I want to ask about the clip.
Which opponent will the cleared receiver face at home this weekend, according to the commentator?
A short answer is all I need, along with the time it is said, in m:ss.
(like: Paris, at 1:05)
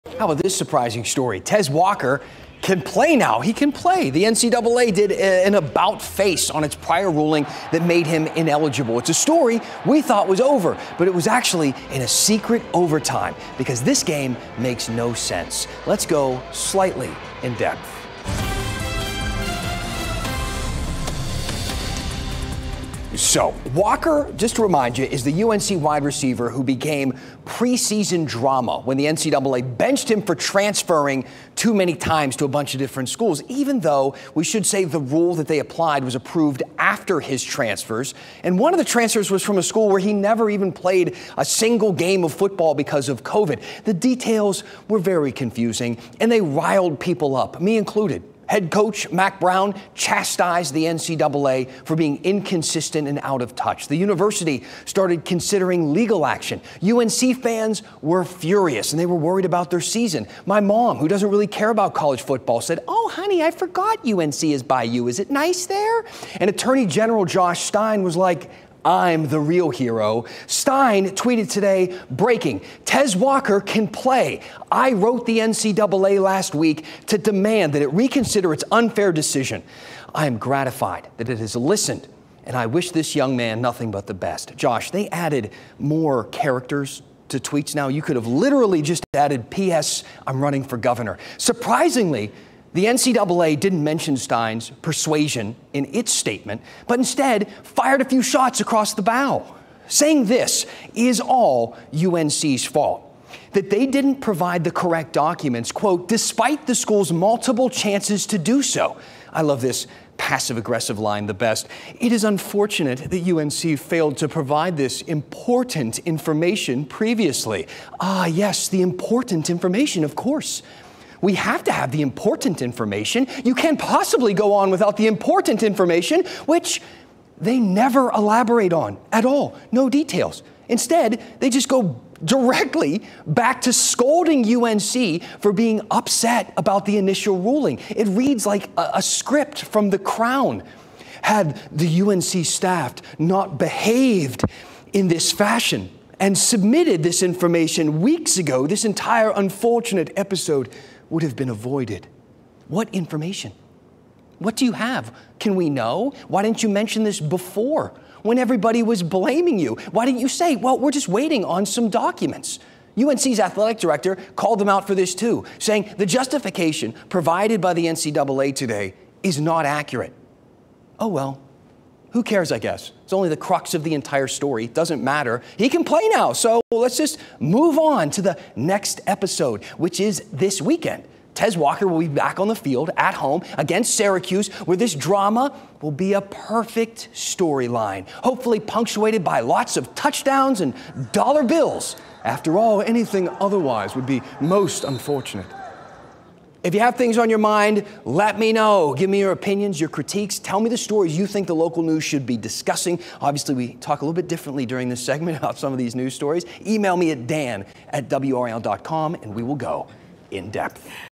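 Syracuse, at 3:03.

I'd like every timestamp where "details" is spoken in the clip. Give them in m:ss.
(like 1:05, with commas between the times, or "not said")
0:43, 2:09.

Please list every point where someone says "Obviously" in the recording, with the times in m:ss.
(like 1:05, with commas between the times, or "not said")
3:23.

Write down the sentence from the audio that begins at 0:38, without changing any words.
And one of the transfers was from a school where he never even played a single game of football because of COVID.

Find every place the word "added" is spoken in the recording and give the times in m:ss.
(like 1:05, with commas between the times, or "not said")
1:25, 1:29.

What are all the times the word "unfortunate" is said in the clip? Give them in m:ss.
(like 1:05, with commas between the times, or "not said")
1:52, 2:29, 3:14.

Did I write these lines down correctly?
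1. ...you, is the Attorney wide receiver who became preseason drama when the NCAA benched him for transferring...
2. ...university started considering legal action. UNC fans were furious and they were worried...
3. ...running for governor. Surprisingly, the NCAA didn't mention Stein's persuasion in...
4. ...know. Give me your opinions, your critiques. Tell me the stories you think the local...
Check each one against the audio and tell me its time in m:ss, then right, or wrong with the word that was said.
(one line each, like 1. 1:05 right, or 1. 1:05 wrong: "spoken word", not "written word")
1. 0:24 wrong: "UNC", not "Attorney"
2. 0:53 right
3. 1:30 right
4. 3:18 right.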